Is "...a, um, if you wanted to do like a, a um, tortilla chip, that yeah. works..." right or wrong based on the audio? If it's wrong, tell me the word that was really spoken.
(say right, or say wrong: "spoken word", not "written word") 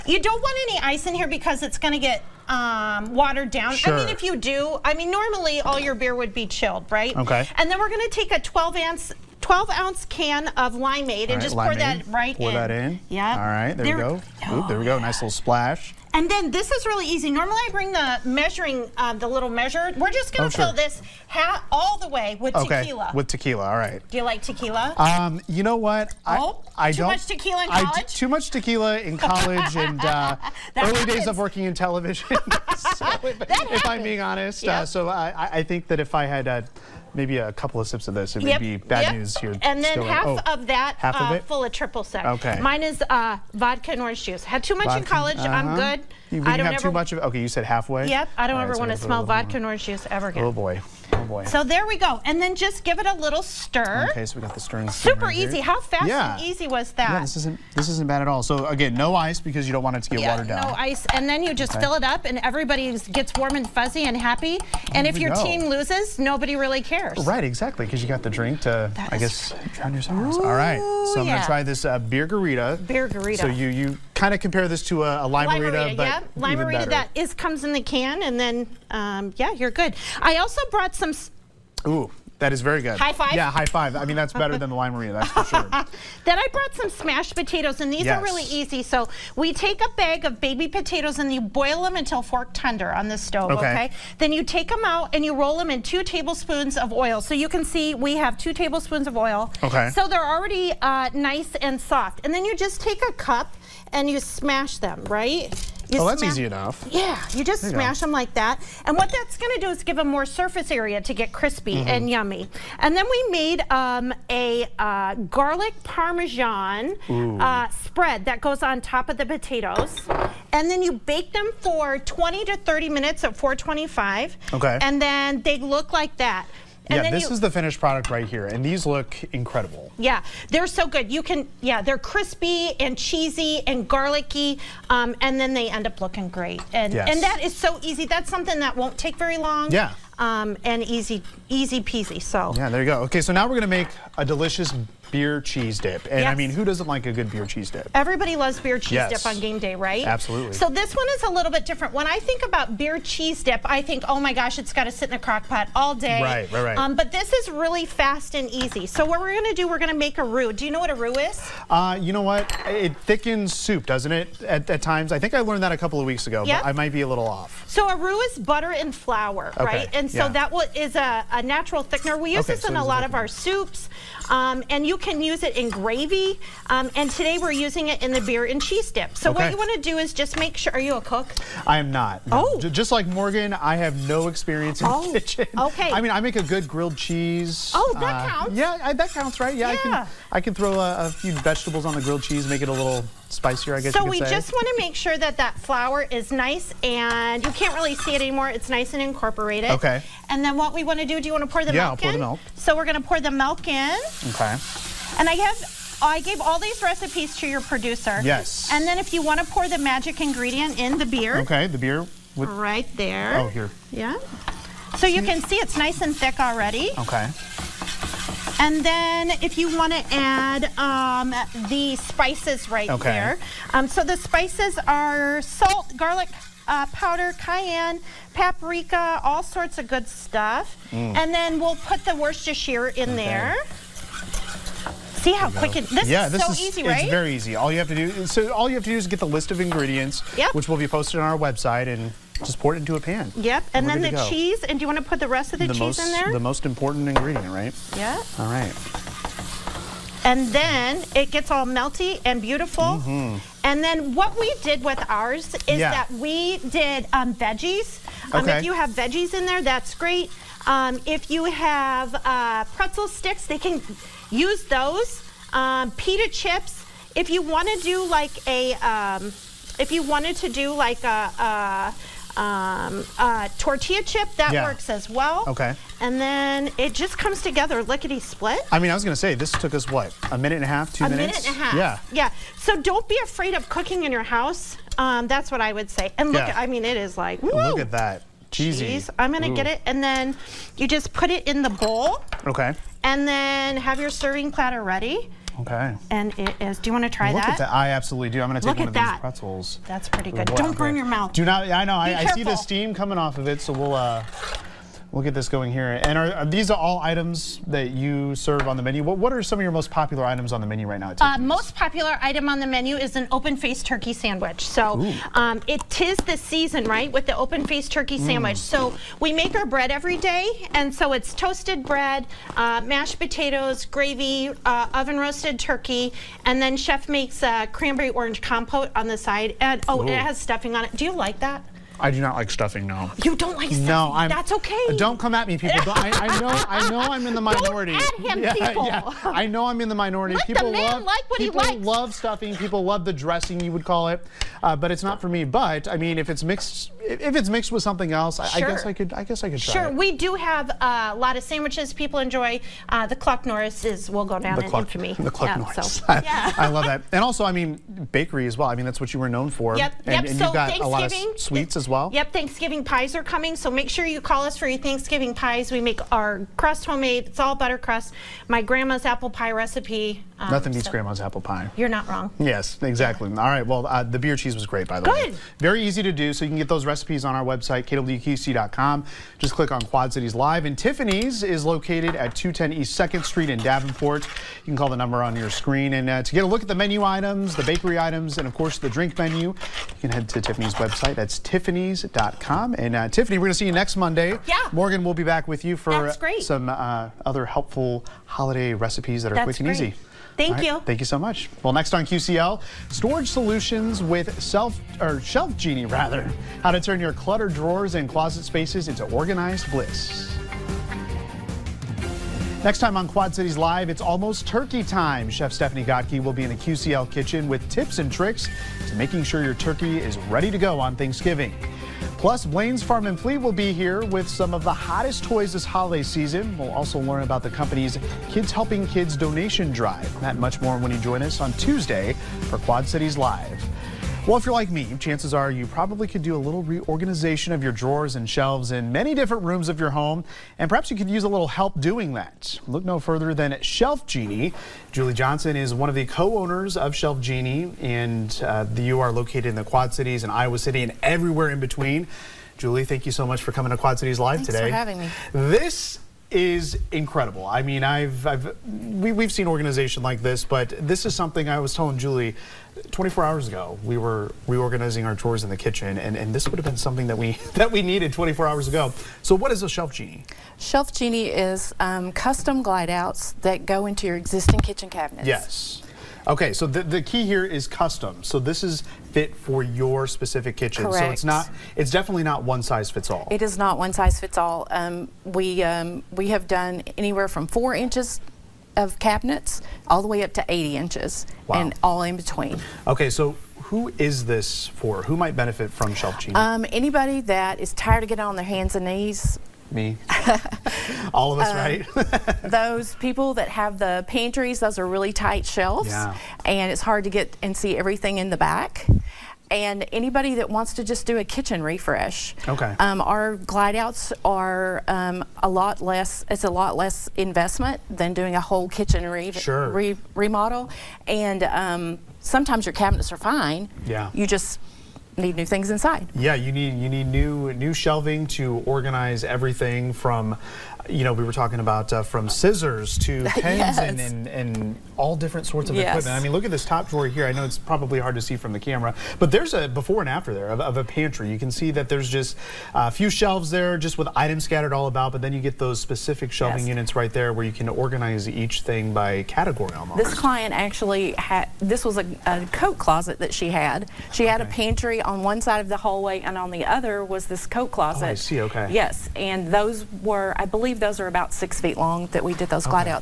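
right.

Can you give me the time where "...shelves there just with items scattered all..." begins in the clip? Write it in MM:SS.
09:03.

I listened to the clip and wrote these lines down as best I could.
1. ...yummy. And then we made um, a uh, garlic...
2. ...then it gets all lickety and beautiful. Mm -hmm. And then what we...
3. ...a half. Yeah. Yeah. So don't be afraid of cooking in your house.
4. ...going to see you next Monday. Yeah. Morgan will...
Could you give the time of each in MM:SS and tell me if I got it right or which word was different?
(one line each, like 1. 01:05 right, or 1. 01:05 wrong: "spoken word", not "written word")
1. 01:52 right
2. 04:10 wrong: "melty", not "lickety"
3. 04:41 right
4. 06:33 right.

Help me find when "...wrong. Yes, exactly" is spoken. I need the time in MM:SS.
06:12.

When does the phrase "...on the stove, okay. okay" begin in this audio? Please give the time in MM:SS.
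01:32.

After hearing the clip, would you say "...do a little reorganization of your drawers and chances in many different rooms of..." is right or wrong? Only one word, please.
wrong.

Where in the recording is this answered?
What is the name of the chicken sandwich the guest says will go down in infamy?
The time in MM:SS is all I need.
05:53.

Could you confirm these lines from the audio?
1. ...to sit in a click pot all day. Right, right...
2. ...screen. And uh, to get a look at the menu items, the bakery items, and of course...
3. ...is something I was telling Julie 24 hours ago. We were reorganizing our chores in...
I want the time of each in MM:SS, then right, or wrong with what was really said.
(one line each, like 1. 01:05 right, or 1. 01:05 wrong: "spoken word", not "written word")
1. 02:34 wrong: "crock", not "click"
2. 06:25 right
3. 07:41 right.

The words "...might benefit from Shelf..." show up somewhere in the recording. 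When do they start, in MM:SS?
08:15.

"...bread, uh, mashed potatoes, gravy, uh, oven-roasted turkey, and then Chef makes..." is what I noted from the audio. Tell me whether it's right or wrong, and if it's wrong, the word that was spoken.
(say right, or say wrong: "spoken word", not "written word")
right.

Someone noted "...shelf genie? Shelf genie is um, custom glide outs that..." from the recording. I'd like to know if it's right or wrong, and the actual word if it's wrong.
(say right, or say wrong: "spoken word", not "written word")
right.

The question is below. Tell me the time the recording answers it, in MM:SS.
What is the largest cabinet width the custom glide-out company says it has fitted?
08:10.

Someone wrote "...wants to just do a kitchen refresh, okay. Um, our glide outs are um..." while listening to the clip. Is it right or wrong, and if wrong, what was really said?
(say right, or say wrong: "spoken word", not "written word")
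right.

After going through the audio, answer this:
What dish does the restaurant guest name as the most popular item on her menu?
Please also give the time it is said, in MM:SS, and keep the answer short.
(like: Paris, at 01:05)
open-faced turkey sandwich, at 05:13.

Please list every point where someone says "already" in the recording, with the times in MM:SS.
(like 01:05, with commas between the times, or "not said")
01:40, 03:36.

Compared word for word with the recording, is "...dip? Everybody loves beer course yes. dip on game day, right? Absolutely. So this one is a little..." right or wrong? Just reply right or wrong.
wrong.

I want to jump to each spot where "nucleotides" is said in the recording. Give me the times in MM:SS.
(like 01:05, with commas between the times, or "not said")
not said.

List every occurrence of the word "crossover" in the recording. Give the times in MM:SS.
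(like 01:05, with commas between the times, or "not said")
not said.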